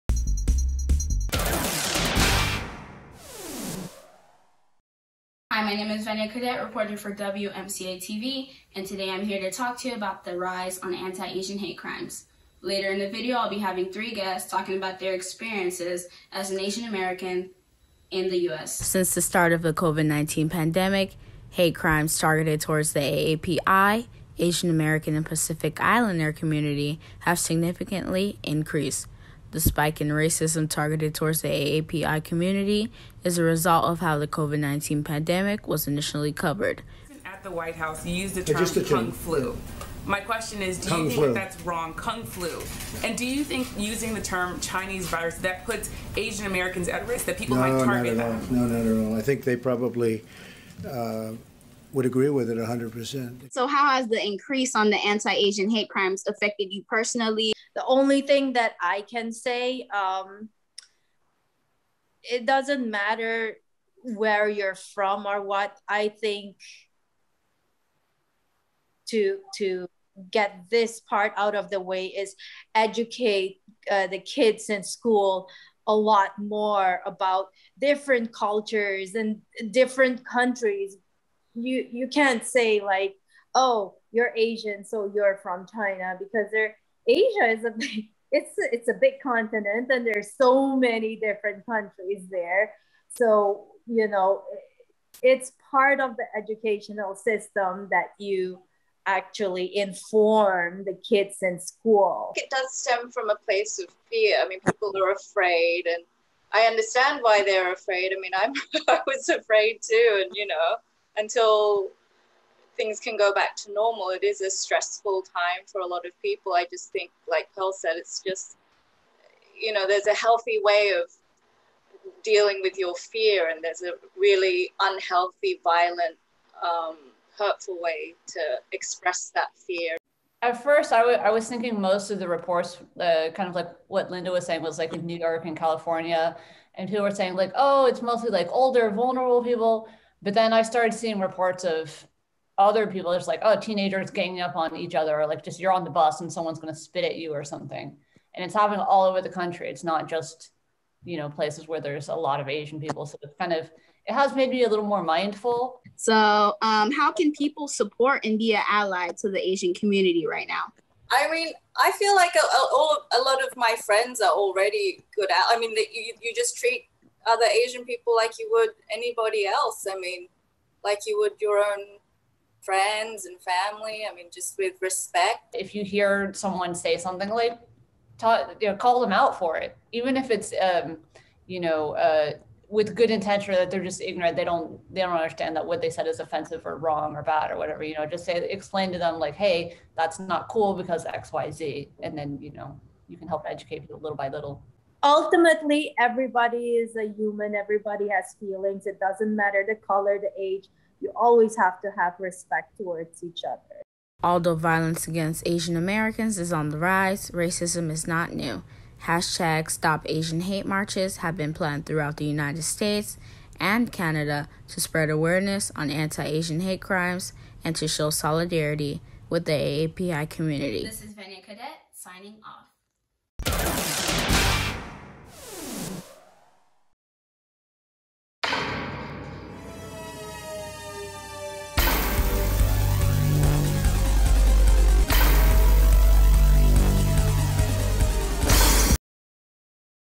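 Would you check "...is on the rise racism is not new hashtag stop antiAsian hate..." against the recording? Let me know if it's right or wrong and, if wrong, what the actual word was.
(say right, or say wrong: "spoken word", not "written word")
wrong: "asian", not "antiAsian".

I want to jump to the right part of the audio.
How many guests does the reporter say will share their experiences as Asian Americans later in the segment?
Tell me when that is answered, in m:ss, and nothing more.
0:13.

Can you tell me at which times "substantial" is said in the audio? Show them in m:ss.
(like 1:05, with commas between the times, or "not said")
not said.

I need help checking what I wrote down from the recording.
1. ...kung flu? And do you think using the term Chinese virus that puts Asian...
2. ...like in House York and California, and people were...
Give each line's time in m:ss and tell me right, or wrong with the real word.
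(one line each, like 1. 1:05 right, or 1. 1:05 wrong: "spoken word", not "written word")
1. 0:41 right
2. 2:14 wrong: "New", not "House".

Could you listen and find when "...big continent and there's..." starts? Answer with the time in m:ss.
1:28.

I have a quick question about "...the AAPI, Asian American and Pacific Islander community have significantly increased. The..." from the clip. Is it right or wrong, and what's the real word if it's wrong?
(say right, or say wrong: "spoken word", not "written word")
right.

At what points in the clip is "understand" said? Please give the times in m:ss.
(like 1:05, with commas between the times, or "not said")
1:46, 3:05.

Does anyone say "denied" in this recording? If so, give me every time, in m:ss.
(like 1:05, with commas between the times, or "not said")
not said.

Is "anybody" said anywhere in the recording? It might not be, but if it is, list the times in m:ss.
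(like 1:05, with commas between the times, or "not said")
2:48.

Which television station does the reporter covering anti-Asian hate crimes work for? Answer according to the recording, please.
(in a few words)
WMCA TV.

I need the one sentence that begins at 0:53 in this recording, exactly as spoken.
So, how has the increase on the anti Asian hate crimes affected you personally?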